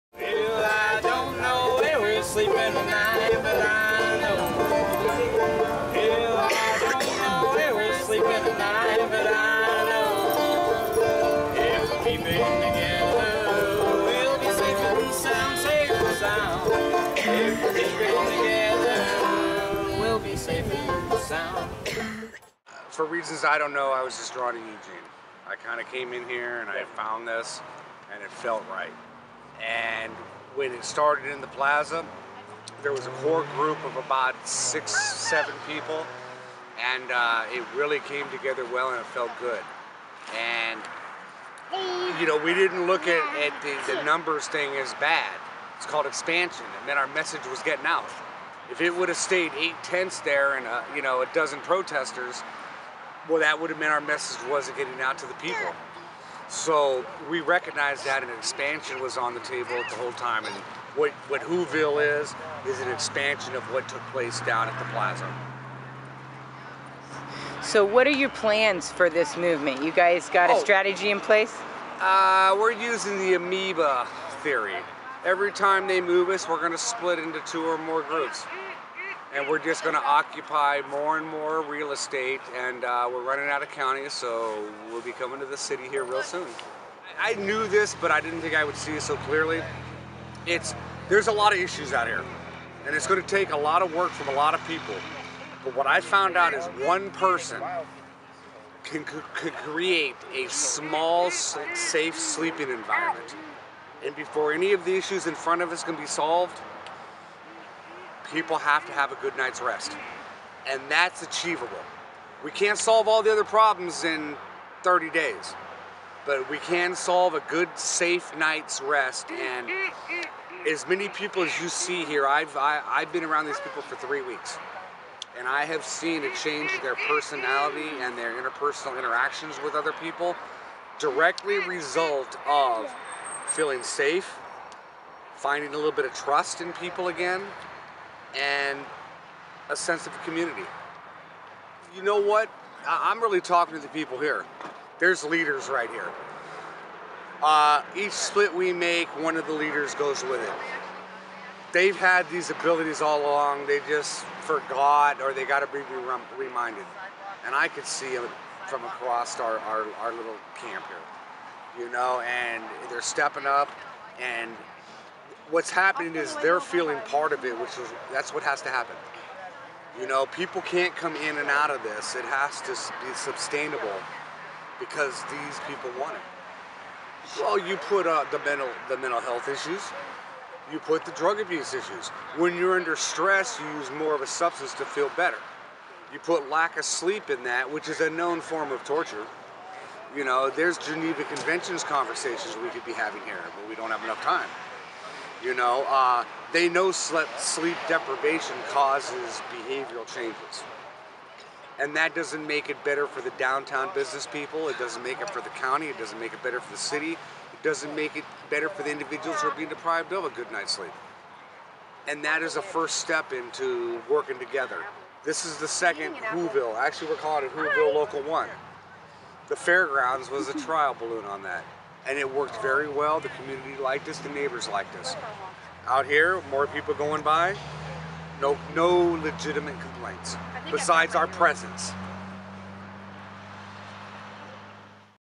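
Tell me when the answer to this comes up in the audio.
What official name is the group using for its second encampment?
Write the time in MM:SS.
03:37.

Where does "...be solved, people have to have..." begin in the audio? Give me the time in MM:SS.
01:45.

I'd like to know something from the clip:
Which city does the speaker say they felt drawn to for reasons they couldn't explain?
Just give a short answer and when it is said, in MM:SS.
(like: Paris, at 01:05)
Eugene, at 00:24.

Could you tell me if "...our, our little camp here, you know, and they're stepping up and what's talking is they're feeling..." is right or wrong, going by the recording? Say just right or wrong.
wrong.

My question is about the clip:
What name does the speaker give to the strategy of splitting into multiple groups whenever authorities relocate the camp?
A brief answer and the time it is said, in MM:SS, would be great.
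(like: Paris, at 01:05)
amoeba theory, at 01:13.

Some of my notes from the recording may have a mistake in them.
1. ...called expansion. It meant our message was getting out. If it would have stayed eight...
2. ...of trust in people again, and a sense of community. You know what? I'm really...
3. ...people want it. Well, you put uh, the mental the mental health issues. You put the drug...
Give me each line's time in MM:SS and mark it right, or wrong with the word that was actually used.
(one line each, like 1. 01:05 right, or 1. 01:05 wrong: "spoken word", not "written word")
1. 00:45 right
2. 02:16 right
3. 02:55 right.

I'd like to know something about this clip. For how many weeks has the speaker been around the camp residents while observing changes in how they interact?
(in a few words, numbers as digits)
3.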